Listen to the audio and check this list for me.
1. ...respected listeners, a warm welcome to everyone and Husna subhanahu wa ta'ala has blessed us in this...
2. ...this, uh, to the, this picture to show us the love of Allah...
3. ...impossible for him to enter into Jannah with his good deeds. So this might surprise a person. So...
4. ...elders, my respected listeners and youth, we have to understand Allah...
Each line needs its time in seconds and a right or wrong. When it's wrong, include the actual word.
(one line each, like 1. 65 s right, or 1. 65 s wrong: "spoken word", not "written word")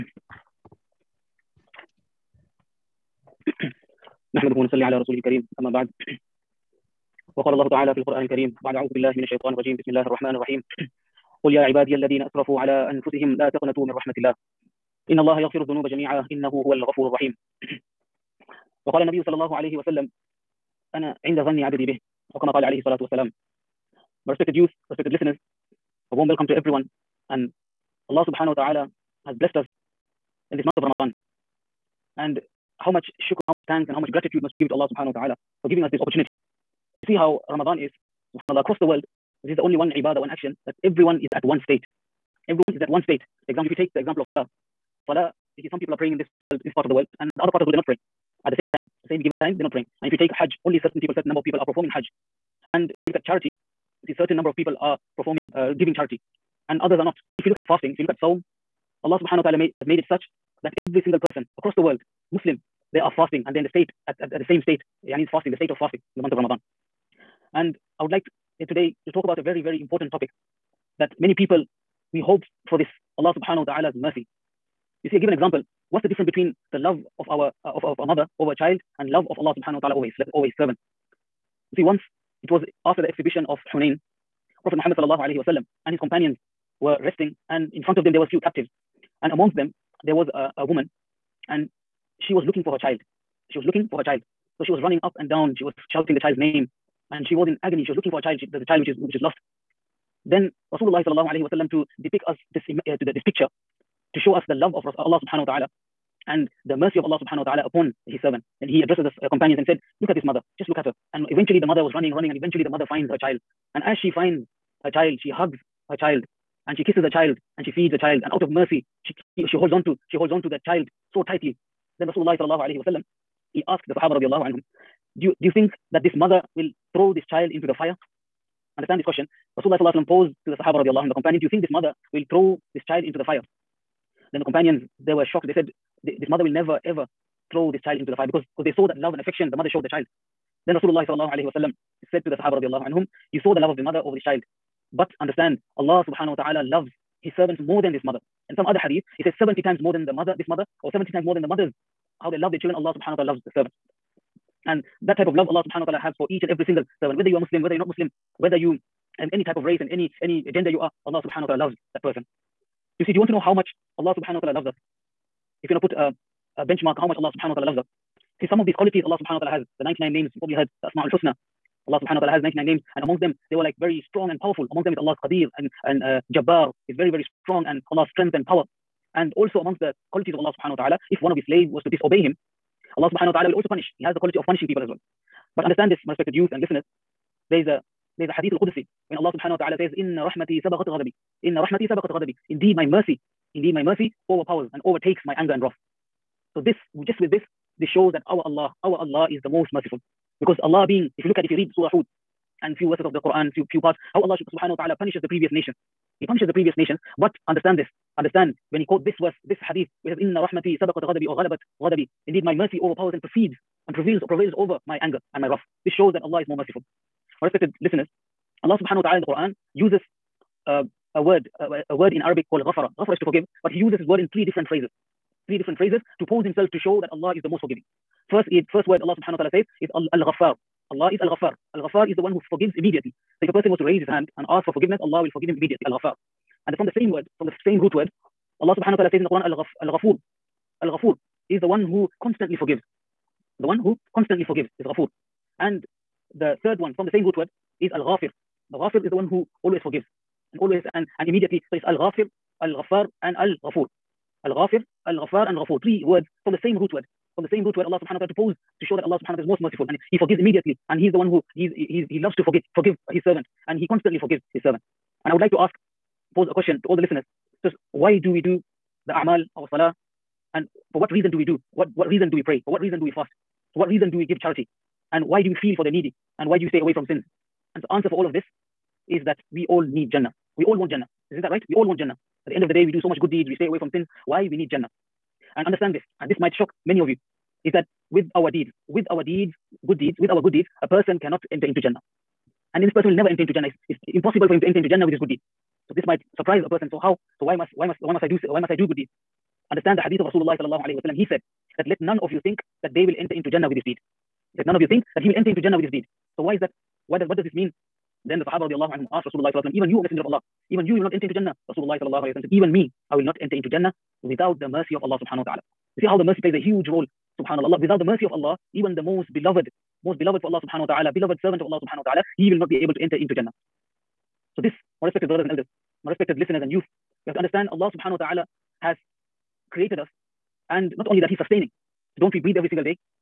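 1. 24 s wrong: "Allah", not "Husna"
2. 102 s right
3. 294 s right
4. 325 s right.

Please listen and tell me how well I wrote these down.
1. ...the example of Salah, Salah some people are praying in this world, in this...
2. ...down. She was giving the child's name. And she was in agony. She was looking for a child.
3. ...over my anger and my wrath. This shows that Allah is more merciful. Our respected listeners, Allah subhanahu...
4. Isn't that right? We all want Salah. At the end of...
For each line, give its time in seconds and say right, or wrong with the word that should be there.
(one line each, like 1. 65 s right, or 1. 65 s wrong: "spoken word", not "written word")
1. 43 s right
2. 95 s wrong: "shouting", not "giving"
3. 214 s right
4. 281 s wrong: "Jannah", not "Salah".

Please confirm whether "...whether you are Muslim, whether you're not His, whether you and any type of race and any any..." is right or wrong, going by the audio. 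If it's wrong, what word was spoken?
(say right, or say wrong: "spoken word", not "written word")
wrong: "Muslim", not "His".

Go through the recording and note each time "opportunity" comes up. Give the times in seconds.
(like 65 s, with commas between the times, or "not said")
36 s.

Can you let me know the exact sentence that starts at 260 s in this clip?
And He is the one who he's, he's, He loves to forget, forgive His servant.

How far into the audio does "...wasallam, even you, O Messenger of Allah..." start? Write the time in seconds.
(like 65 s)
309 s.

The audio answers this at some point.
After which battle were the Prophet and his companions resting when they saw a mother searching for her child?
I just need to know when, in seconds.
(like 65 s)
83 s.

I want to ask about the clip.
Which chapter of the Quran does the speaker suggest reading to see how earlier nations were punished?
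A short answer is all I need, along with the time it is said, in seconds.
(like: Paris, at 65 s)
Surah Hud, at 201 s.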